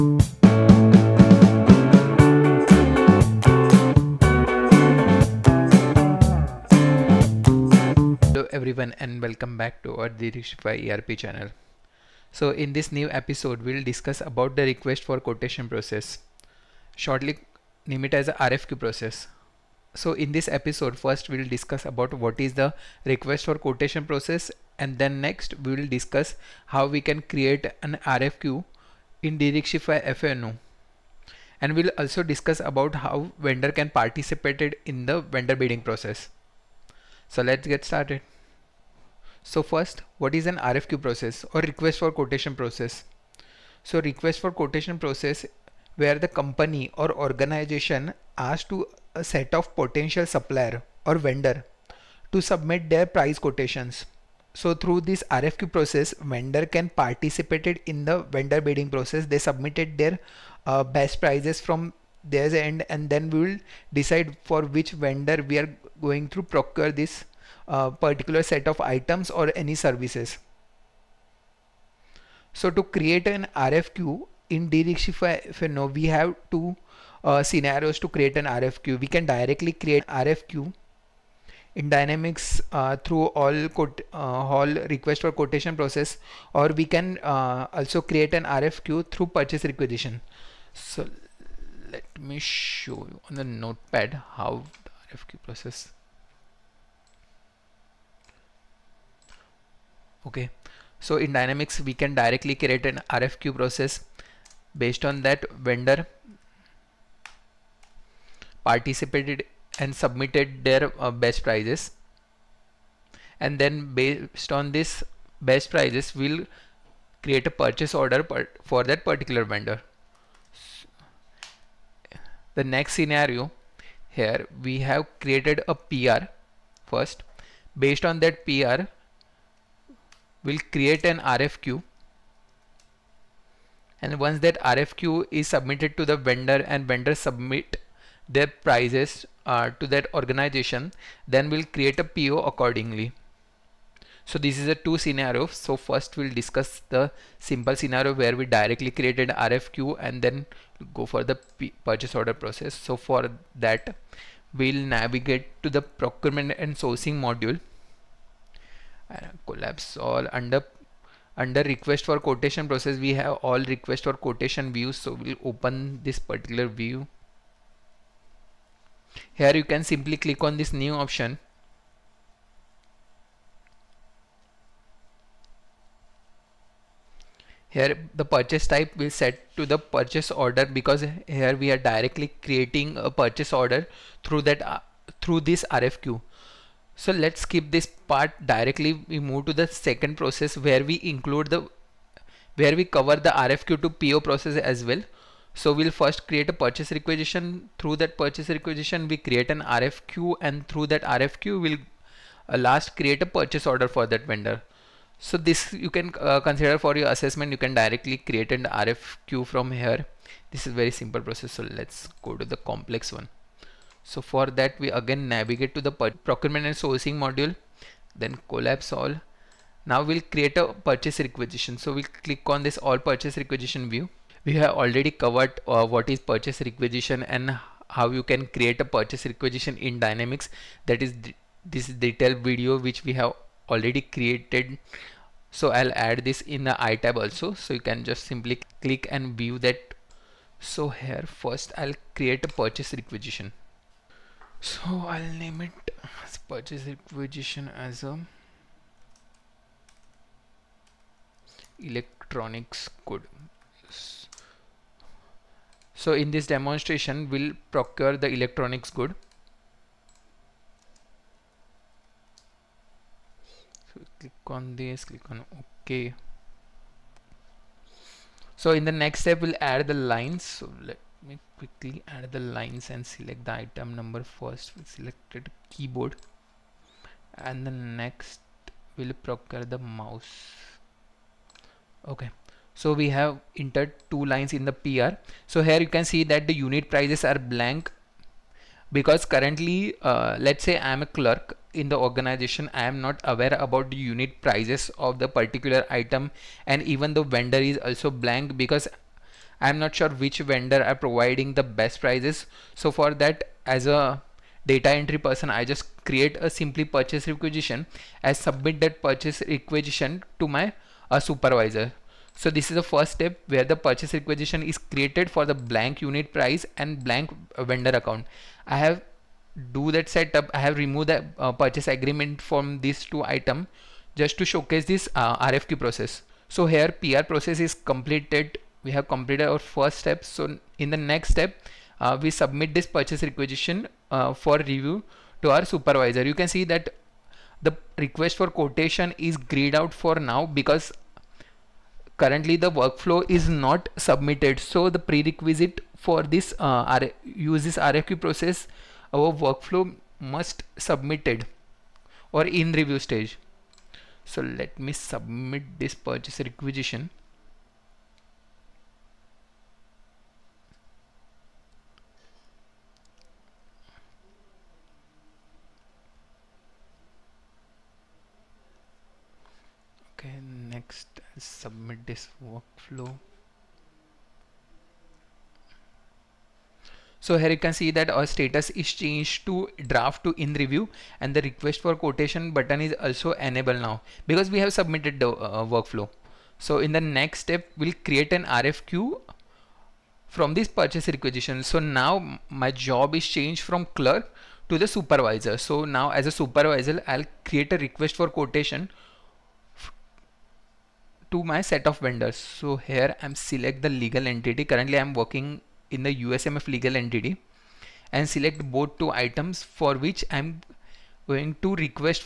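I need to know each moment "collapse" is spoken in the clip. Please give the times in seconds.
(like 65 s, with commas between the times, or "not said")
159 s, 218 s.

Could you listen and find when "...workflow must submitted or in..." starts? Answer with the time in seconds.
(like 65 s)
349 s.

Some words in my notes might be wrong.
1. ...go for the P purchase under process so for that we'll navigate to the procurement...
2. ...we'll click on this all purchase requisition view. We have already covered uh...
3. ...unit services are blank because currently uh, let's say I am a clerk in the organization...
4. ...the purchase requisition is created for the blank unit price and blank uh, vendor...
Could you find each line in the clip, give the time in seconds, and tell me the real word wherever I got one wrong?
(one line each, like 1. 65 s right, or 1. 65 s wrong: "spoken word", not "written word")
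1. 150 s wrong: "order", not "under"
2. 221 s right
3. 286 s wrong: "prices", not "services"
4. 313 s right.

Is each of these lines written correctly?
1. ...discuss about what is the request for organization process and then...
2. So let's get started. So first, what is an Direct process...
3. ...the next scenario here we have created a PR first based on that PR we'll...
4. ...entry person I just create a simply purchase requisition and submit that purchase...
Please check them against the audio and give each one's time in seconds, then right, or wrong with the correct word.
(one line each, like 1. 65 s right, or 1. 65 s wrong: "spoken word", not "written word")
1. 21 s wrong: "quotation", not "organization"
2. 37 s wrong: "RFQ", not "Direct"
3. 122 s right
4. 304 s right.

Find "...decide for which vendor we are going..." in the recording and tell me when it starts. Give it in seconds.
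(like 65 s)
63 s.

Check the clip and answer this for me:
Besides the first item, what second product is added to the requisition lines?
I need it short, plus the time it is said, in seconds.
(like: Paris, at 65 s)
Mouse, at 279 s.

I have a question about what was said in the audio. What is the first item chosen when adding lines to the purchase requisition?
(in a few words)
Keyboard.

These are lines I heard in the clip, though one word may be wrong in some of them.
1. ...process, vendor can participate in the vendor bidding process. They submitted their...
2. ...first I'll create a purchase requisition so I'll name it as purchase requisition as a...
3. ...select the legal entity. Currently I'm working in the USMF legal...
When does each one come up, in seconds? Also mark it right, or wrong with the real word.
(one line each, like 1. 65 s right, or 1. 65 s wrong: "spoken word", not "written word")
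1. 55 s right
2. 241 s right
3. 403 s right.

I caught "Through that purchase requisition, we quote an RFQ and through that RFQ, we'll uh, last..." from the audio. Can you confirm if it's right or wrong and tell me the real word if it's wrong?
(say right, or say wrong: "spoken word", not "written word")
wrong: "create", not "quote".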